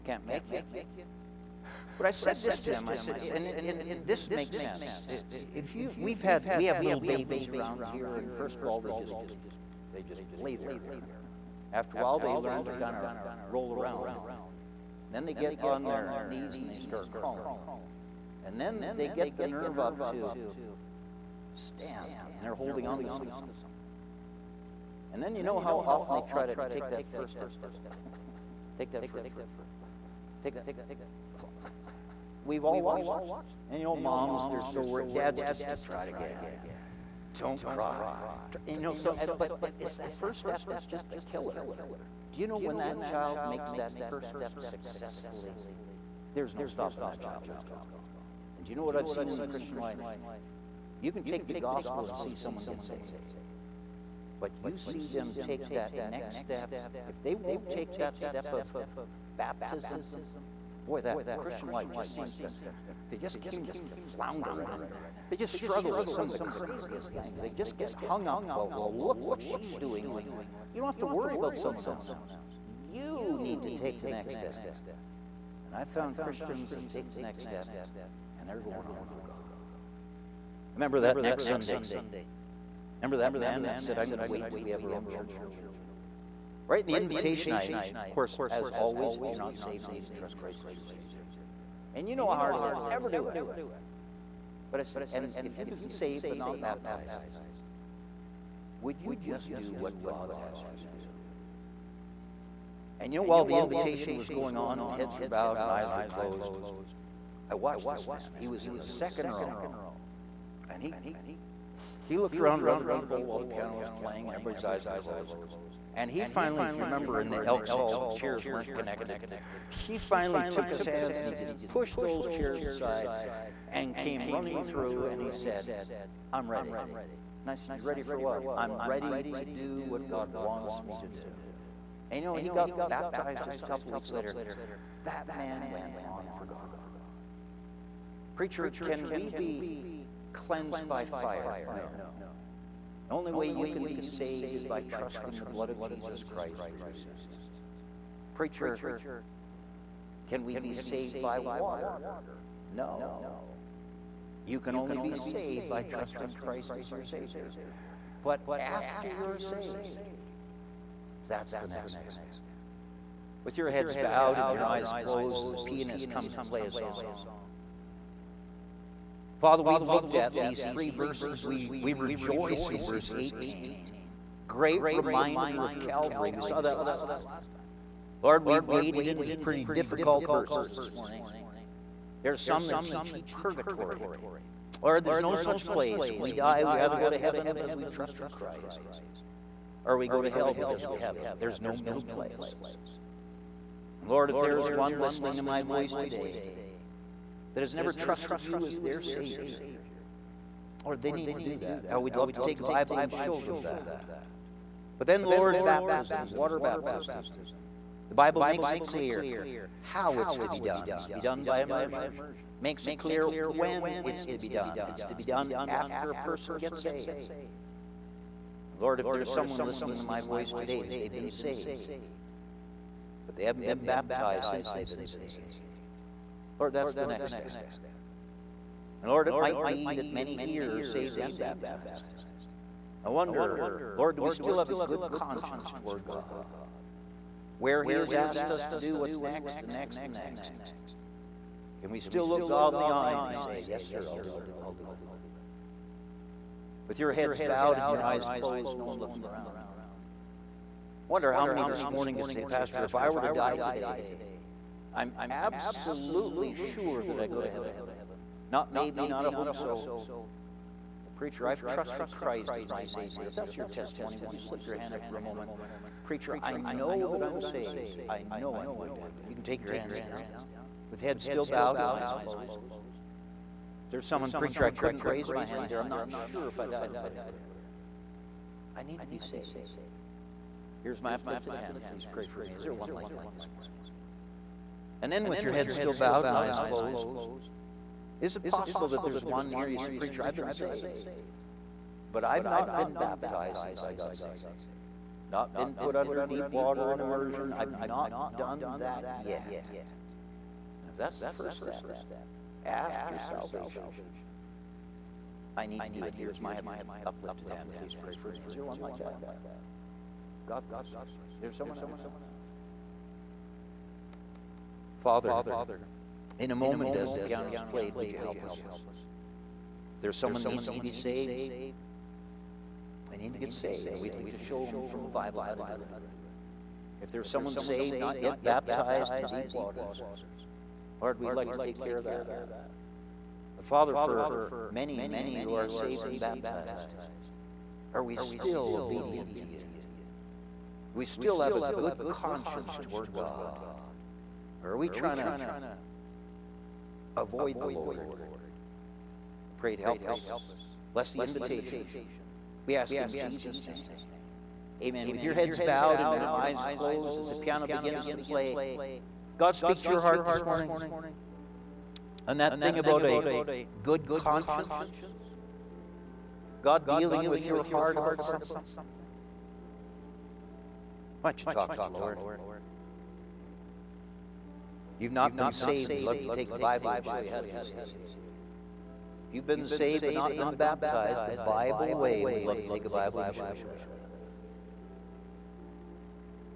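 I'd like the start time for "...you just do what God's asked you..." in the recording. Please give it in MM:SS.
01:39.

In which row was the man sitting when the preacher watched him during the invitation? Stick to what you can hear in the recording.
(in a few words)
Second row.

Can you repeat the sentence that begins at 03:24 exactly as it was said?
But then, Lord, baptism, water baptism.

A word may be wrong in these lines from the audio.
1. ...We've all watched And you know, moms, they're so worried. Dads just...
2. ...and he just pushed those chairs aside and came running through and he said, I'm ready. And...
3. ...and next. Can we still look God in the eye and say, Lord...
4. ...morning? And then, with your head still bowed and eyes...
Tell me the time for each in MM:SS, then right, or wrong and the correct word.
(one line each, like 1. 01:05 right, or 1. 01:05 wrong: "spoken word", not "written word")
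1. 00:32 right
2. 02:01 right
3. 04:00 wrong: "Yes", not "Lord"
4. 04:43 right.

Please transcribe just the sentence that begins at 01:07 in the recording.
They just get hung up about, well, look what she's doing.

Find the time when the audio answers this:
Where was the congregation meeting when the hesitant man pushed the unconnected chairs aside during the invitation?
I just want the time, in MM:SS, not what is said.
01:57.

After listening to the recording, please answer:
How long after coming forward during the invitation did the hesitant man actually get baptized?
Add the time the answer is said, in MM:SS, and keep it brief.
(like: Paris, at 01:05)
A couple weeks later, at 02:13.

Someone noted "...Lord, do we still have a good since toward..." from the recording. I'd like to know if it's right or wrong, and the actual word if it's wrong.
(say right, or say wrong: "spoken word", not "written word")
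wrong: "conscience", not "since".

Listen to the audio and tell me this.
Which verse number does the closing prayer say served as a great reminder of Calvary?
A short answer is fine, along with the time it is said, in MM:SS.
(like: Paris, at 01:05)
Verse 18, at 02:52.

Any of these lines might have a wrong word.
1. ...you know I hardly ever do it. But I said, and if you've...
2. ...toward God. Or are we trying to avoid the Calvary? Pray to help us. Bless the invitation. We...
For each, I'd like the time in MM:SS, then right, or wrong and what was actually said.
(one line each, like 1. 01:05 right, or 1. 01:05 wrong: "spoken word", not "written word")
1. 01:32 right
2. 05:42 wrong: "Lord", not "Calvary".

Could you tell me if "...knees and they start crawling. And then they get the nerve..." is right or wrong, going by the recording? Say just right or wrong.
right.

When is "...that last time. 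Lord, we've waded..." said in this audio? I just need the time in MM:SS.
02:56.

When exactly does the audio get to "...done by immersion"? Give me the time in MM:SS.
03:31.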